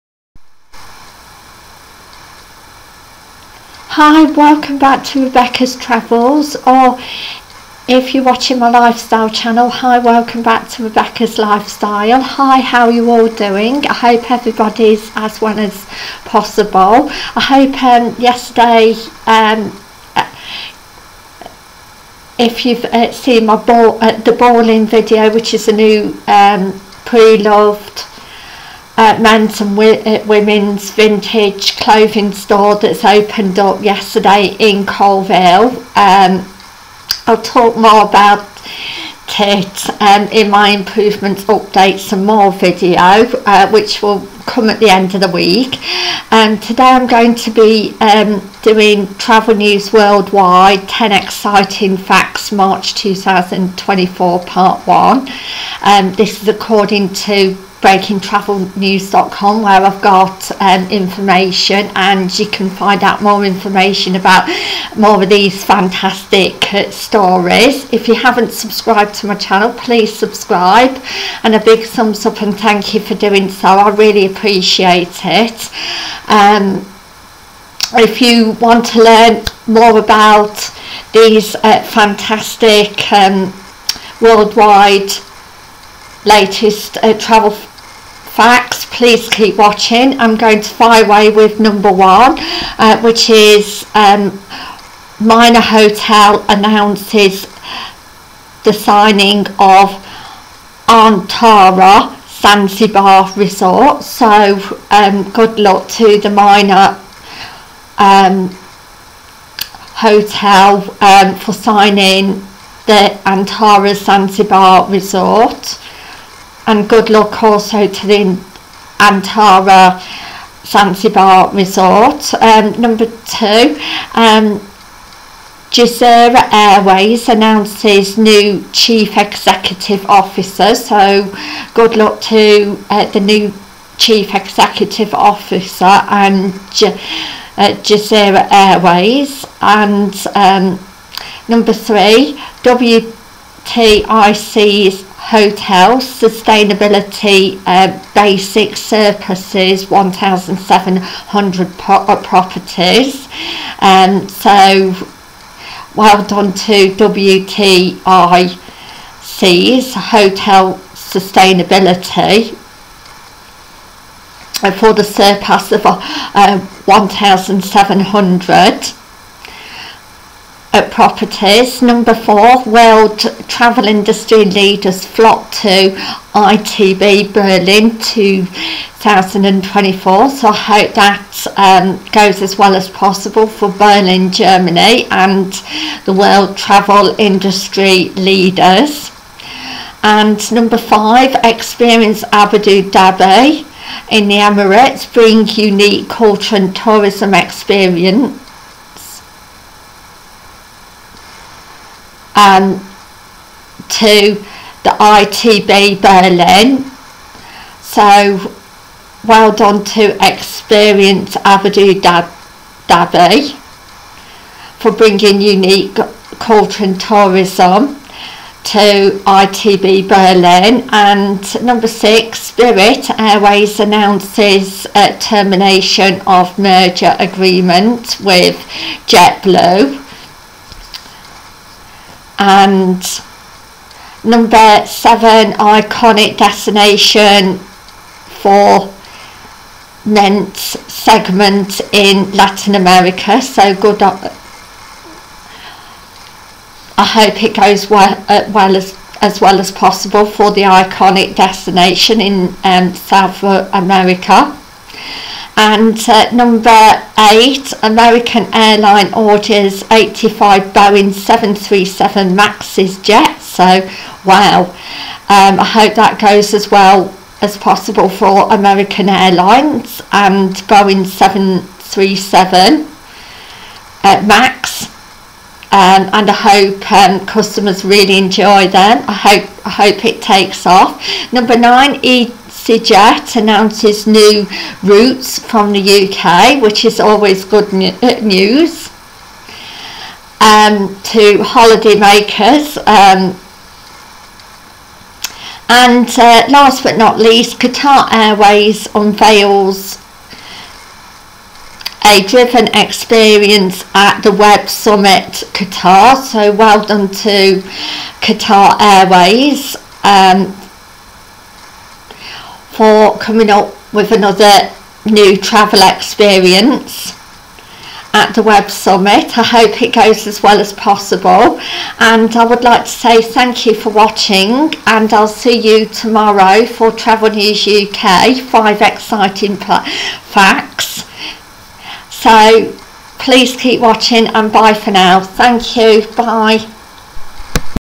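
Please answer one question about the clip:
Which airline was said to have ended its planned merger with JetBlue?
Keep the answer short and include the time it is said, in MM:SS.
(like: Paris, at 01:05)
Spirit Airways, at 03:42.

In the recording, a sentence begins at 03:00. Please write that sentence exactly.
So I hope that um, goes as well as possible for Berlin, Germany and the world travel industry leaders.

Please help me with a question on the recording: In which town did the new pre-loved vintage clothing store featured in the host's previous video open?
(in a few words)
Colville.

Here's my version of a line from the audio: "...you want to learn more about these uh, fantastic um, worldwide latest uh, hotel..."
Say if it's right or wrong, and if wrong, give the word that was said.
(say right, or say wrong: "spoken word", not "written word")
wrong: "travel", not "hotel".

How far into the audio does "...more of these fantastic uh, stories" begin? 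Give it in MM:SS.
01:04.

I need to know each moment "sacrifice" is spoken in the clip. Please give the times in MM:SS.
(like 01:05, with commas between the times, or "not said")
not said.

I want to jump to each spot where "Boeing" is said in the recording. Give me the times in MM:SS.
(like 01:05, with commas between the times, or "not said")
04:20, 04:30.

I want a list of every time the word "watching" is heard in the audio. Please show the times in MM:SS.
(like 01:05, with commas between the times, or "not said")
00:08, 01:29, 05:23, 05:33.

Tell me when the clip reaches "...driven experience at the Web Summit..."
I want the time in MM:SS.
05:02.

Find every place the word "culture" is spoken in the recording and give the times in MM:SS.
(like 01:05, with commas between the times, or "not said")
03:16, 03:36.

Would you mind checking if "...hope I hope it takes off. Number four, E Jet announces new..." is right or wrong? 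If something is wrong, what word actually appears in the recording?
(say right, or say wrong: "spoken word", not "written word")
wrong: "nine", not "four".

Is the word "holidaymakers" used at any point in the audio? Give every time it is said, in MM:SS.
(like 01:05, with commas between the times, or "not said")
04:51.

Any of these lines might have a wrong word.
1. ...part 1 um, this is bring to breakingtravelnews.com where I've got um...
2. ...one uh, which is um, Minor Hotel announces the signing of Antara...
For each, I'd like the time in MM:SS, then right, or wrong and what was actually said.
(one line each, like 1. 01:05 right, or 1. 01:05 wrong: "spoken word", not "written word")
1. 00:54 wrong: "according", not "bring"
2. 01:31 right.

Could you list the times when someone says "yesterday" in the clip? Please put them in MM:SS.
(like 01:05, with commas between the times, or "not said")
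00:18, 00:33.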